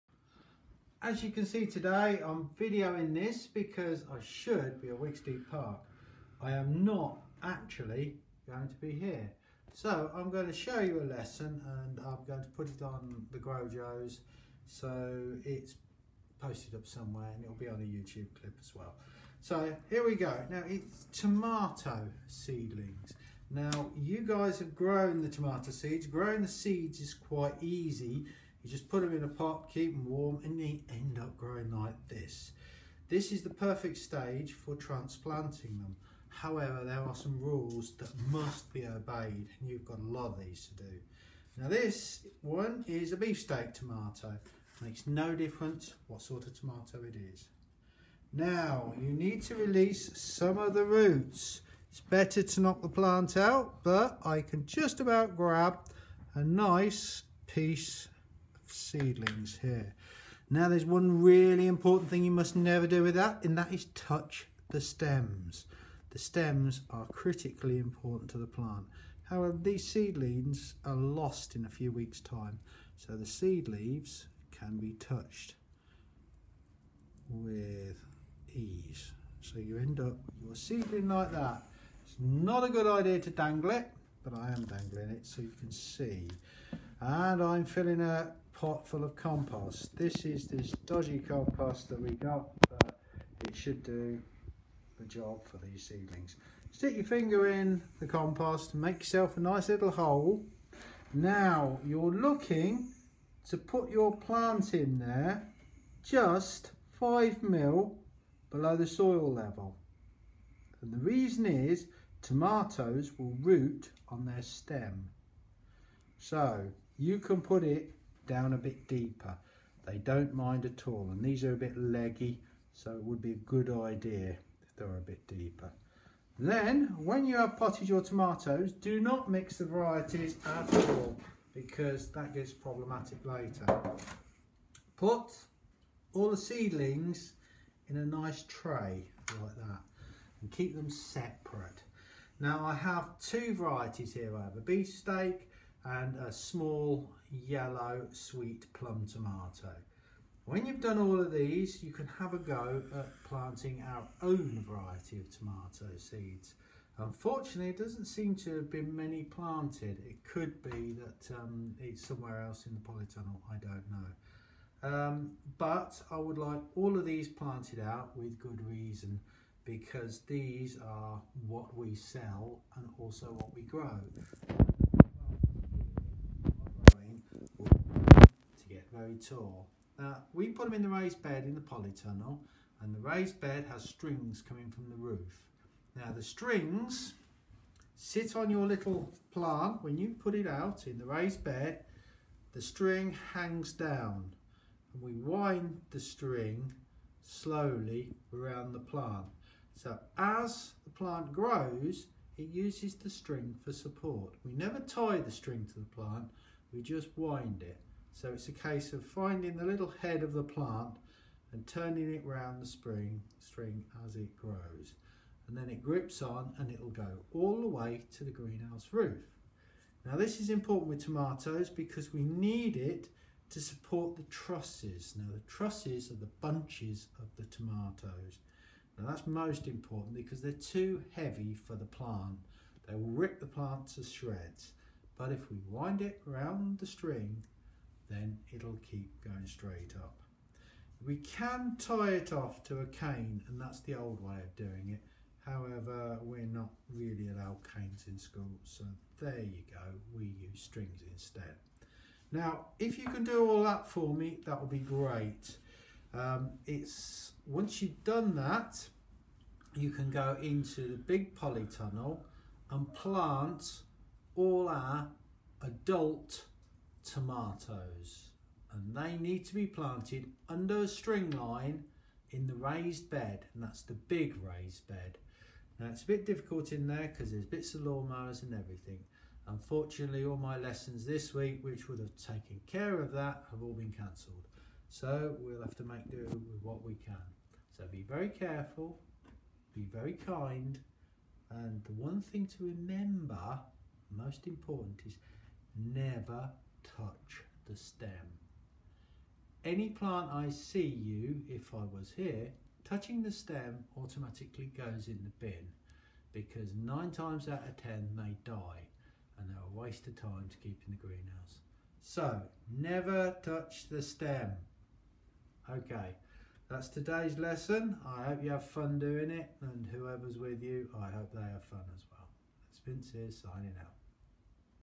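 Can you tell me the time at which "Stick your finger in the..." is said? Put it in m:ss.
1:36.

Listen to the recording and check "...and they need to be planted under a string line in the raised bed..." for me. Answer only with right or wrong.
right.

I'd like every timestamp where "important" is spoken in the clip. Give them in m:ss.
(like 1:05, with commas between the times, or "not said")
1:01, 1:07, 3:40, 3:49, 4:54.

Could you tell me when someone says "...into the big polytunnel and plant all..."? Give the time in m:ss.
4:20.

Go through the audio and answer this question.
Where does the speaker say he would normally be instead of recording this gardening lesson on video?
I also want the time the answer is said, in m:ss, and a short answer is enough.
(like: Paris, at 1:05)
Wigsteed Park, at 0:04.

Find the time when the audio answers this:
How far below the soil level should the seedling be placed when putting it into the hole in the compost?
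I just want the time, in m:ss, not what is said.
1:46.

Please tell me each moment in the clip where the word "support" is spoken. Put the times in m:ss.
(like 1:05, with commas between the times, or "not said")
3:23, 3:43.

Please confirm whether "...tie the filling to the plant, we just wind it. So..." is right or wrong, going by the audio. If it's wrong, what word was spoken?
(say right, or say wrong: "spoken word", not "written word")
wrong: "string", not "filling".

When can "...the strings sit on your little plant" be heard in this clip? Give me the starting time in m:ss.
3:06.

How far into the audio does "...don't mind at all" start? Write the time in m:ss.
1:59.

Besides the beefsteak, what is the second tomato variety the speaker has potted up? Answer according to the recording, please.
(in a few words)
Small yellow sweet plum.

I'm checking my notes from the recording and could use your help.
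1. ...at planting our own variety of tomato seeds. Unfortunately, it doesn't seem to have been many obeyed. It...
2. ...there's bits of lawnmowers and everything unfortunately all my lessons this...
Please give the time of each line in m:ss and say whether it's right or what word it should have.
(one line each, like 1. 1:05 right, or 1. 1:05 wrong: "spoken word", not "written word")
1. 2:32 wrong: "planted", not "obeyed"
2. 4:37 right.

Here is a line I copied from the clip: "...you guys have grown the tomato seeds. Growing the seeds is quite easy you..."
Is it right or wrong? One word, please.
right.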